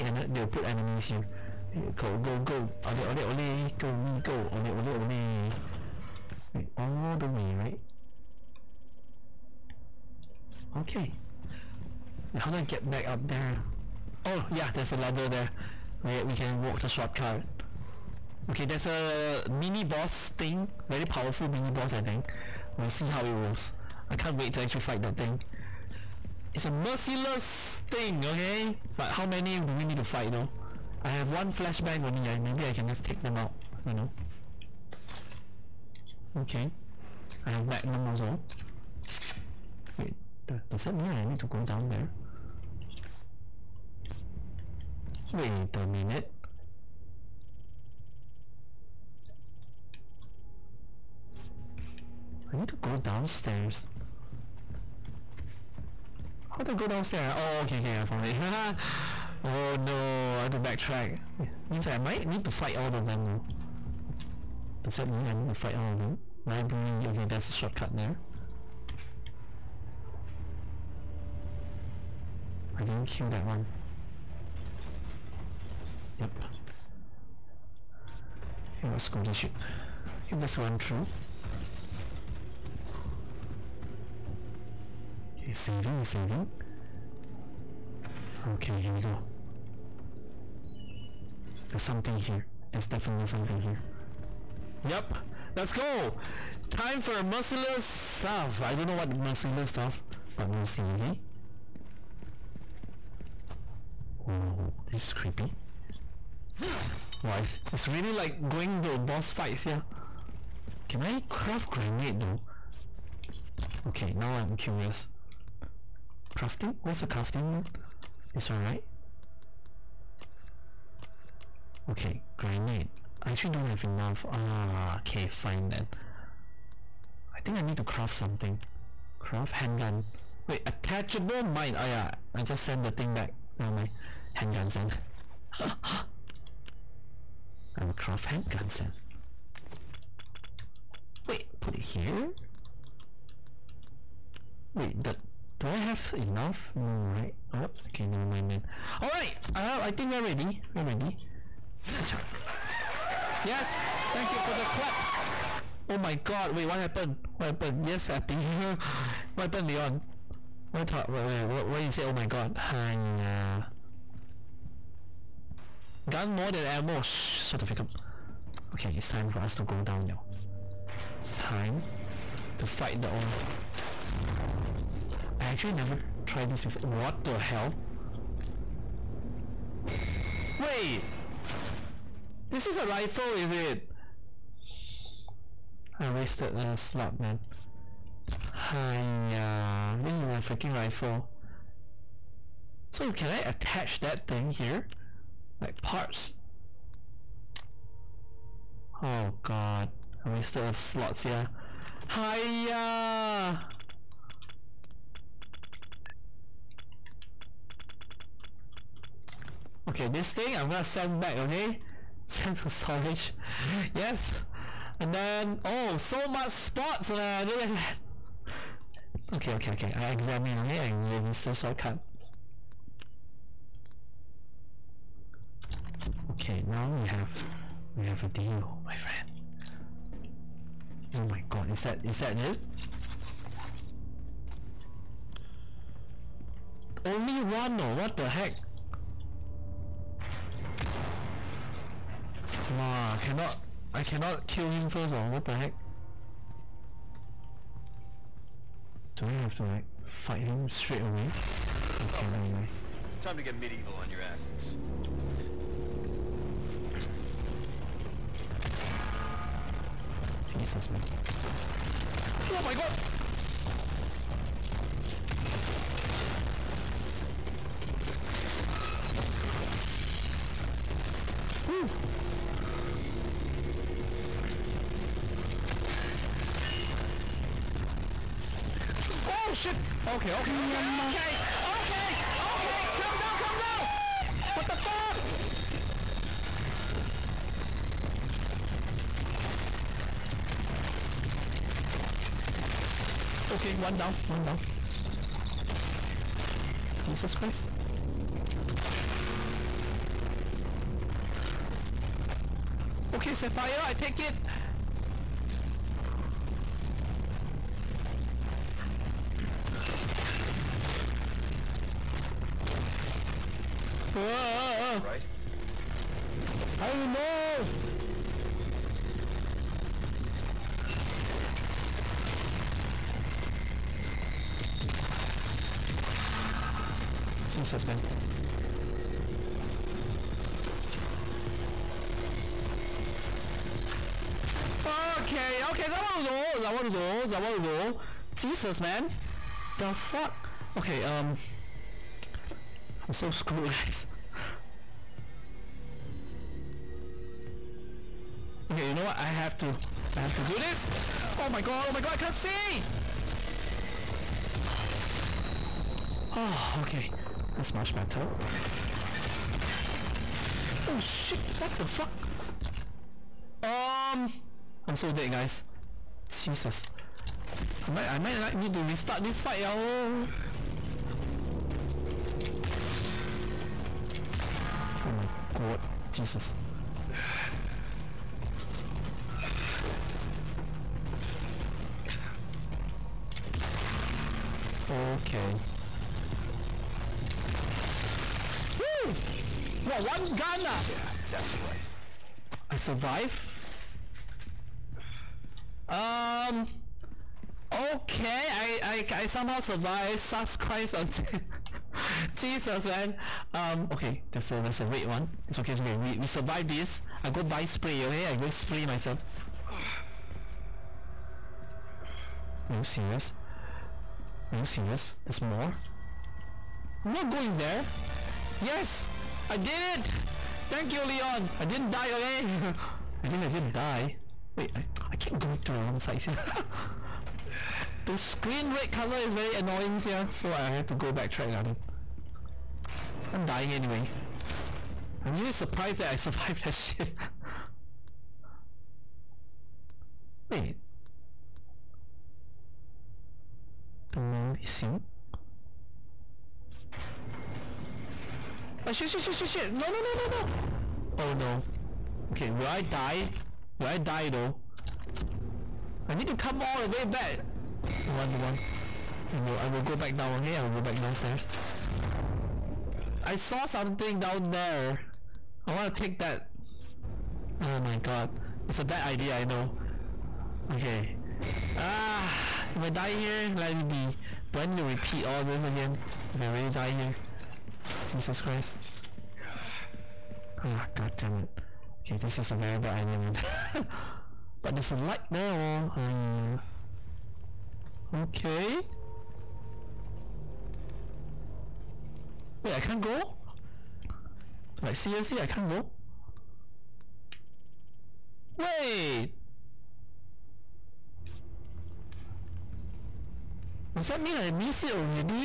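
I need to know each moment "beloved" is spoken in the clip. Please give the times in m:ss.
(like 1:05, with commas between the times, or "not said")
not said.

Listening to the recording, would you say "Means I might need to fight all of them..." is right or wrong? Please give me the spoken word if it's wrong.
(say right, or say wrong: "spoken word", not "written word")
right.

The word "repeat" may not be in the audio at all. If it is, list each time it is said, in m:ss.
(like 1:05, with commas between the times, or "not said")
7:54.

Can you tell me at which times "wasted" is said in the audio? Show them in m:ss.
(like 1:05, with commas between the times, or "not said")
3:06, 3:20.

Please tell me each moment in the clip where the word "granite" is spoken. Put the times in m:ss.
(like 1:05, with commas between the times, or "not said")
2:02.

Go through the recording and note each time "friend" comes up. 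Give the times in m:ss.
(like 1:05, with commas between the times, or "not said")
3:48.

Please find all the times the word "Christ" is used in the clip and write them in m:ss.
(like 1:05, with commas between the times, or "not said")
4:57, 6:40, 7:58.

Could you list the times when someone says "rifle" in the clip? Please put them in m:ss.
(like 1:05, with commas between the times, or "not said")
3:02, 3:10.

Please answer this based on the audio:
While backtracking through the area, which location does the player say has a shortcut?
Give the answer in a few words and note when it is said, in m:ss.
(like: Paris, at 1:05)
Library, at 1:06.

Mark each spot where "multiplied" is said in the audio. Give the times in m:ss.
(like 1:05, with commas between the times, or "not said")
not said.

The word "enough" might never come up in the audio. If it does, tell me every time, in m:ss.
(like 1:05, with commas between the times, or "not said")
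2:03, 2:26.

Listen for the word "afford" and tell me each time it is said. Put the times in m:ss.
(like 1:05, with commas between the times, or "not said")
not said.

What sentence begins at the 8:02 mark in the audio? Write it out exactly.
Okay, this is a very bad idea, man.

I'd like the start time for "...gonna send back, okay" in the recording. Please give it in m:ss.
3:30.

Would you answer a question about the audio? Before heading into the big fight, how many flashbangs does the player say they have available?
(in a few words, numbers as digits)
1.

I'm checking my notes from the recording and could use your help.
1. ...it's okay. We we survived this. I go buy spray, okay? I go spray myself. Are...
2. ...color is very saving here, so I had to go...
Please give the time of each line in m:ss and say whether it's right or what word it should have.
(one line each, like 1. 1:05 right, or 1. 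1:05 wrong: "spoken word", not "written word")
1. 6:45 right
2. 7:08 wrong: "annoying", not "saving".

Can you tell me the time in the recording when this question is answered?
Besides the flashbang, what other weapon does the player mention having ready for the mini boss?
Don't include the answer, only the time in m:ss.
0:37.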